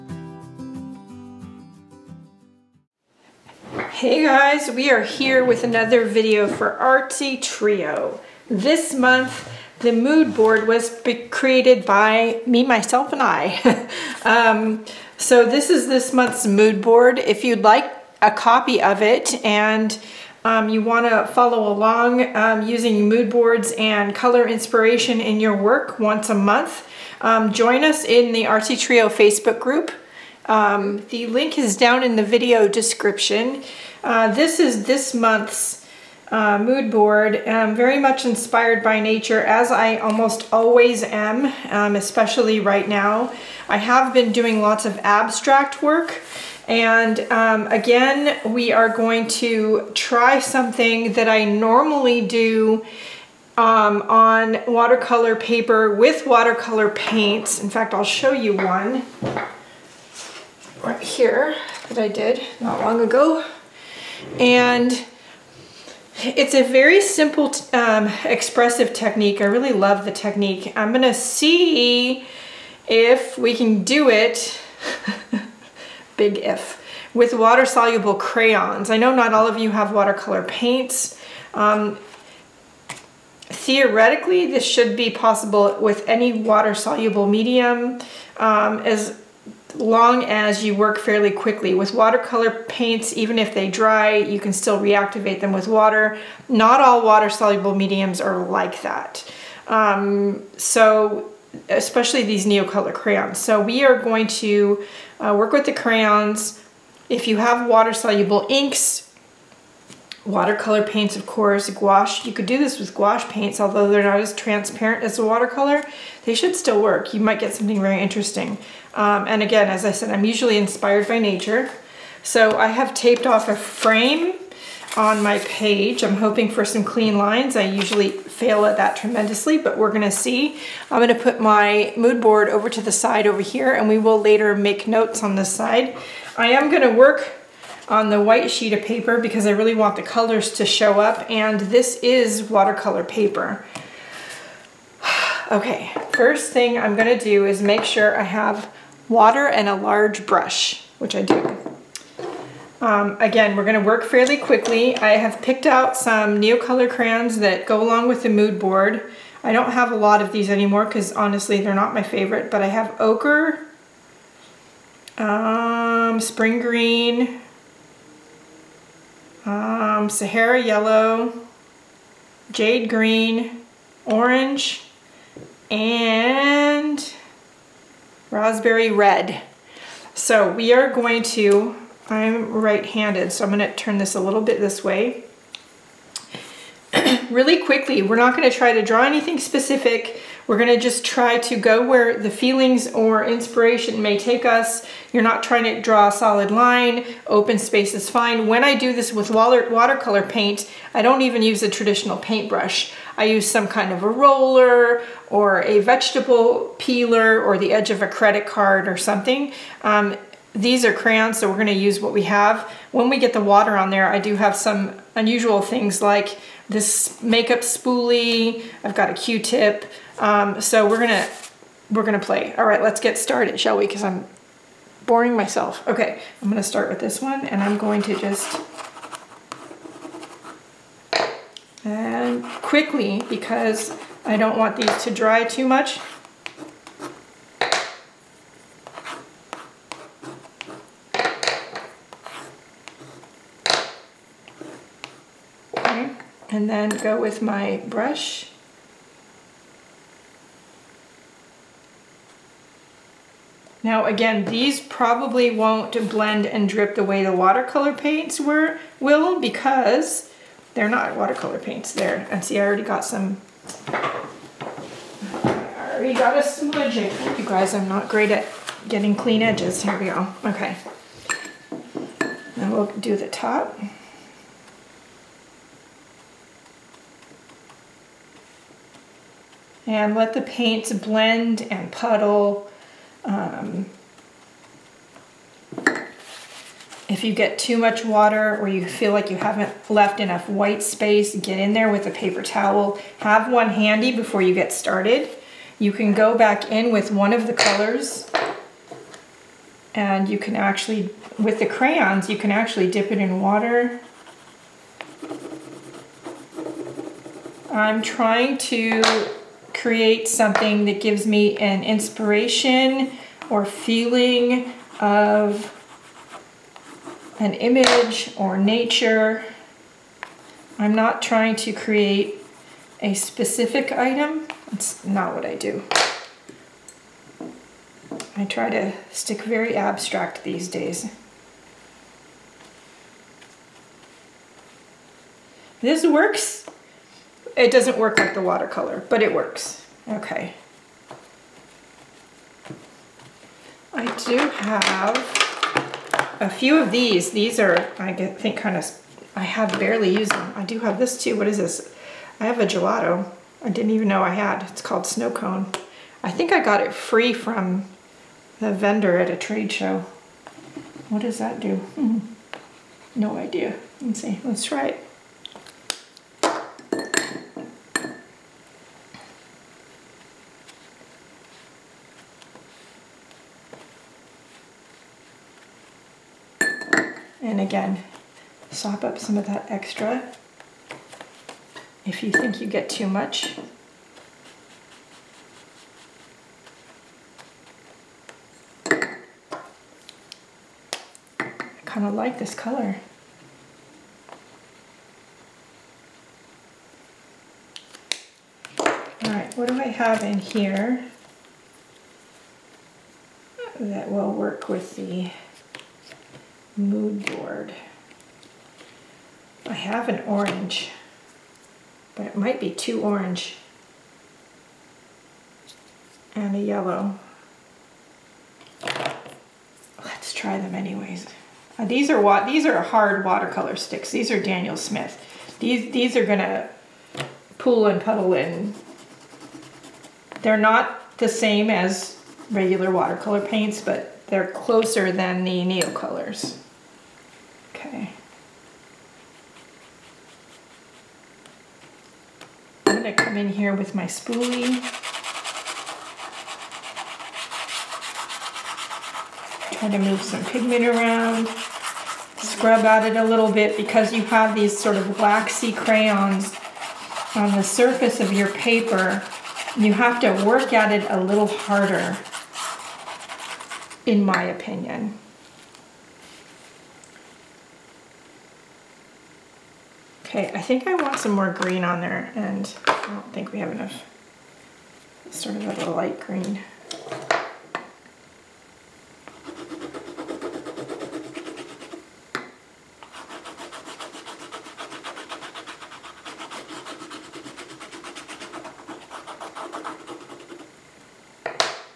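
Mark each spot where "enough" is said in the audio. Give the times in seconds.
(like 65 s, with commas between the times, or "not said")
290 s, 473 s.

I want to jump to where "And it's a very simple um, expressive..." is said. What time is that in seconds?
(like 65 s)
64 s.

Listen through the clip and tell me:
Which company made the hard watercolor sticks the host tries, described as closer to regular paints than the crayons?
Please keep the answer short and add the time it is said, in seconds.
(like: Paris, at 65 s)
Daniel Smith, at 424 s.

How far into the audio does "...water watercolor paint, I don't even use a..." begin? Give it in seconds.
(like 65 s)
199 s.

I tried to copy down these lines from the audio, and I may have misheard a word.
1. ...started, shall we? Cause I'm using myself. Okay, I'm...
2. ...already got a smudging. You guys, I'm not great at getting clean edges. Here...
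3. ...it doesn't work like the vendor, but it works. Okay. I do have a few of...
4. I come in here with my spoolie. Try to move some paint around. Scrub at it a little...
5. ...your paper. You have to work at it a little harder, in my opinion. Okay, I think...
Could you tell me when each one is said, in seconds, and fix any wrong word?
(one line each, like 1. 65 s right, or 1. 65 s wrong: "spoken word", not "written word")
1. 223 s wrong: "boring", not "using"
2. 265 s right
3. 337 s wrong: "watercolor", not "vendor"
4. 443 s wrong: "pigment", not "paint"
5. 458 s right.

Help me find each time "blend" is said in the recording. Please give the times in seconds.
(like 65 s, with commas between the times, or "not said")
256 s, 280 s.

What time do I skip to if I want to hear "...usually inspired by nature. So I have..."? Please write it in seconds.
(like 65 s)
120 s.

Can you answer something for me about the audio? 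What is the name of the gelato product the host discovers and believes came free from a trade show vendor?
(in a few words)
Snow Cone.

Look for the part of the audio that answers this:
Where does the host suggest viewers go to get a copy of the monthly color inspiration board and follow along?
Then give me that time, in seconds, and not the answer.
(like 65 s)
28 s.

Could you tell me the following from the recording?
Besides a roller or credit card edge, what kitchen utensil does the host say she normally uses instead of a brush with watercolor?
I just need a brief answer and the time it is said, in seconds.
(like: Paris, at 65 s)
vegetable peeler, at 205 s.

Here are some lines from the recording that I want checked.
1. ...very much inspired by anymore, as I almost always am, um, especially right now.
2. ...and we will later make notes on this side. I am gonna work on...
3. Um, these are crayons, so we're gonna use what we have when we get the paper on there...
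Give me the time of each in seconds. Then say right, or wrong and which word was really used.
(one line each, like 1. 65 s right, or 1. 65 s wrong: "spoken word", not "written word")
1. 37 s wrong: "nature", not "anymore"
2. 133 s right
3. 209 s wrong: "water", not "paper".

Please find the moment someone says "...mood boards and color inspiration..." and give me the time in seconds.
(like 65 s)
23 s.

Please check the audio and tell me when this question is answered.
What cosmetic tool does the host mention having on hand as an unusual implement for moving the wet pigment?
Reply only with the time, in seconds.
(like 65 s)
217 s.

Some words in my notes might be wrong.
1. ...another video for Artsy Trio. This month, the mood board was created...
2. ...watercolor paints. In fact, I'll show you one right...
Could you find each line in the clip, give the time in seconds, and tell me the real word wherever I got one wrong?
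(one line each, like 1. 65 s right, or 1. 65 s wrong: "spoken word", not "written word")
1. 5 s right
2. 56 s right.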